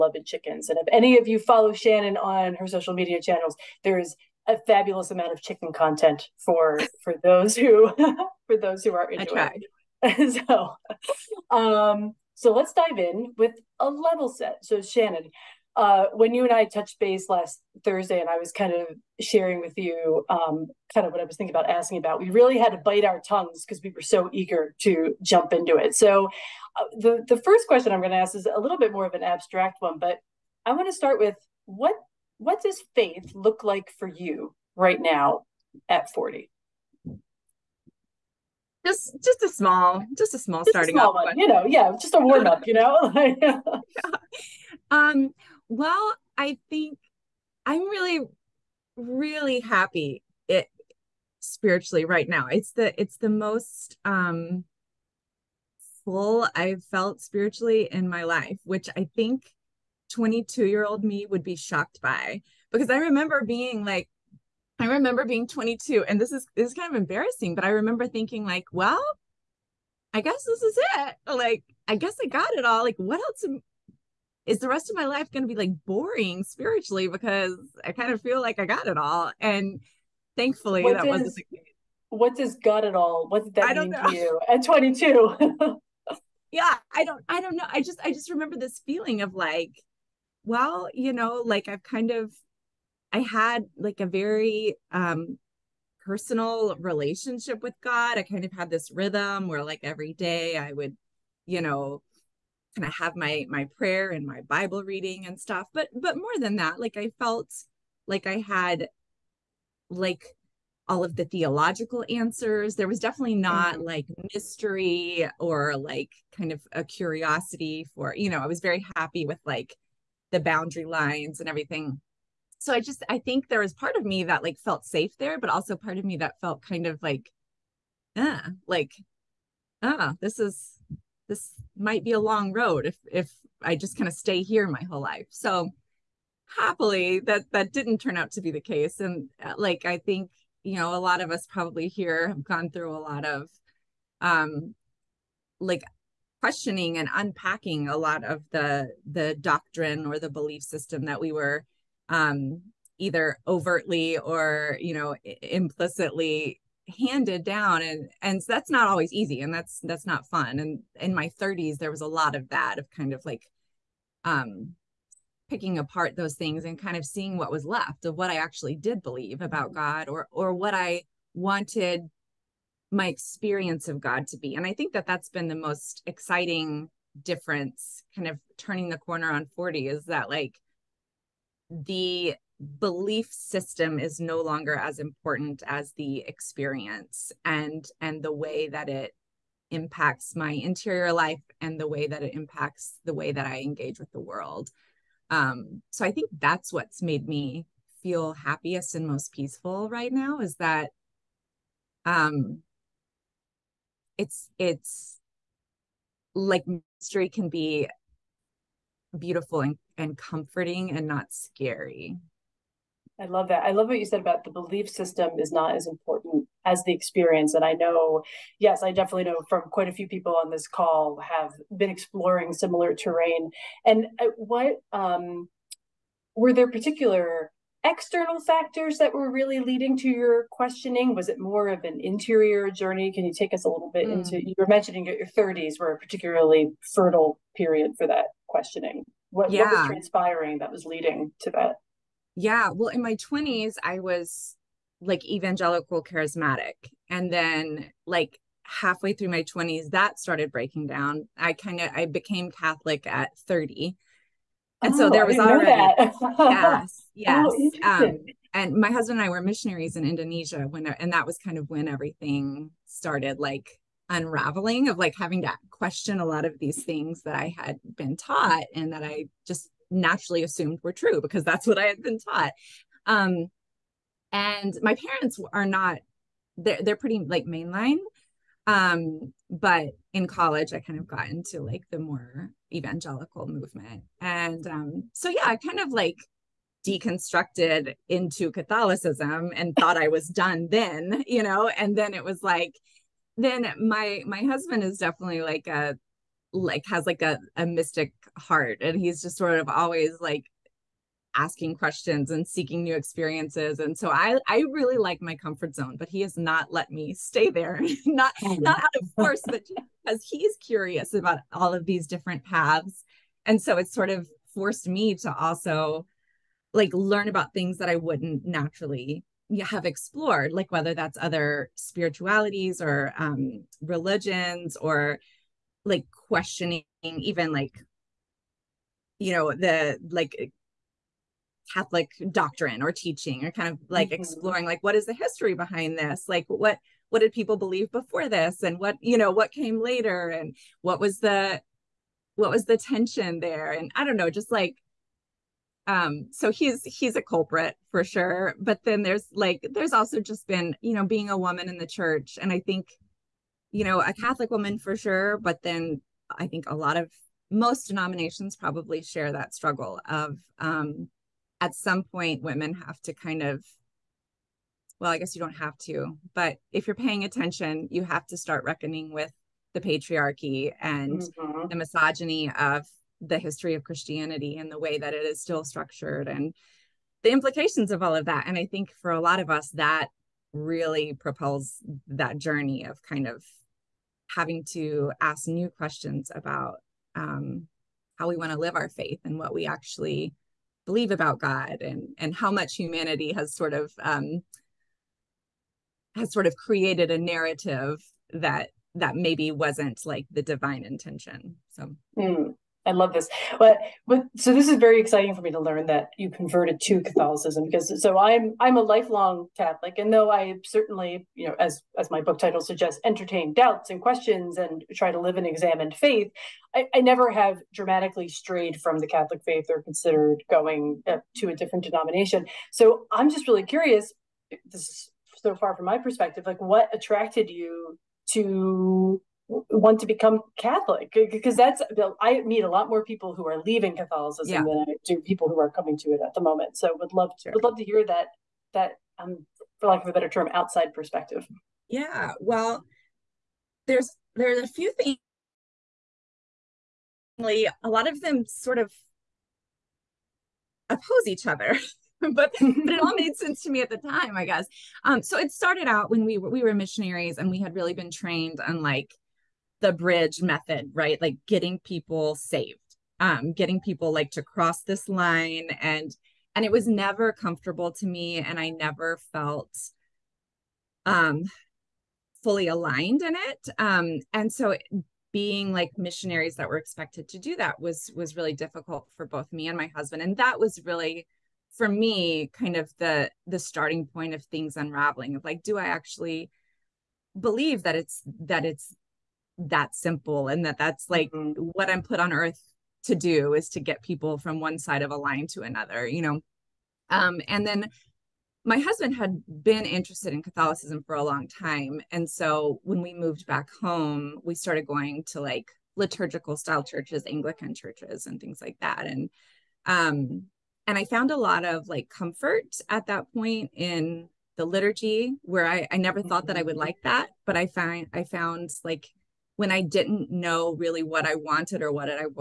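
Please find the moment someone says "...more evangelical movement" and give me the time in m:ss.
4:41.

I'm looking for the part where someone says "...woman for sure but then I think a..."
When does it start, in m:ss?
5:54.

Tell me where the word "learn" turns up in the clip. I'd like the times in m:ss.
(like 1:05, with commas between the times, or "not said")
5:16, 6:45.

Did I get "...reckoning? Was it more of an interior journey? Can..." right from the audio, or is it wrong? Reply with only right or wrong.
wrong.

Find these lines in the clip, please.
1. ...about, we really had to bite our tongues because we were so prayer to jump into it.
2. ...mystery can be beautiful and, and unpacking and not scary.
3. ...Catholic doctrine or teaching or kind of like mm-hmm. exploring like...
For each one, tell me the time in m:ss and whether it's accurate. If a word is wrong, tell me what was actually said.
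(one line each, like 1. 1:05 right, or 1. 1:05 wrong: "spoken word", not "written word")
1. 0:21 wrong: "eager", not "prayer"
2. 3:26 wrong: "comforting", not "unpacking"
3. 5:31 right.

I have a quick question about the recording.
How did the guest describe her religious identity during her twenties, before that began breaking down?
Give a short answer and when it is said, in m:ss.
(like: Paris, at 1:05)
Evangelical charismatic, at 4:05.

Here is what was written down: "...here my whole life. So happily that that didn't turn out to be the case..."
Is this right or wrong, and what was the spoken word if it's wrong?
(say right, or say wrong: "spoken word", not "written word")
right.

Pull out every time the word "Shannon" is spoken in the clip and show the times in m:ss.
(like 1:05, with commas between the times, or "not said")
0:01, 0:14.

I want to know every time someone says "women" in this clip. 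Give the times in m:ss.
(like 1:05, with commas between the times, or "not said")
6:02.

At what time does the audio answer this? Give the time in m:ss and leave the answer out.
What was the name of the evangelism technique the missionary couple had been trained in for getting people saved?
7:39.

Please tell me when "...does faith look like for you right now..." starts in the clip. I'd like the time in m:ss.
0:32.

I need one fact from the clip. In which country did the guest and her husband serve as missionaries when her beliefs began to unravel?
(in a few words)
Indonesia.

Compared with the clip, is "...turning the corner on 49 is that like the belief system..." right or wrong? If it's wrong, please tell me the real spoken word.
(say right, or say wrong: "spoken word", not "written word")
wrong: "40", not "49".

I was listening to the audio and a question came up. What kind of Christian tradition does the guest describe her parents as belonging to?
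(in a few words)
Mainline.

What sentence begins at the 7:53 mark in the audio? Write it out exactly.
Um, and so being like missionaries that were expected to do that was was really difficult for both me and my husband.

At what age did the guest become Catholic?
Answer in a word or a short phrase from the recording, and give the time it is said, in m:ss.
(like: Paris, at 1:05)
30, at 4:13.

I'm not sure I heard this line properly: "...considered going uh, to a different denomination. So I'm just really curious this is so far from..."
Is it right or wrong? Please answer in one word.
right.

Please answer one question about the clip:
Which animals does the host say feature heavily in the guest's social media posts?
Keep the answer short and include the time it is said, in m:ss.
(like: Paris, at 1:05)
Chickens, at 0:00.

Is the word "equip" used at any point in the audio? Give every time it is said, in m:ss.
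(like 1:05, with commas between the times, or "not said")
not said.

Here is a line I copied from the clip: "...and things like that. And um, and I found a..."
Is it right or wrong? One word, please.
right.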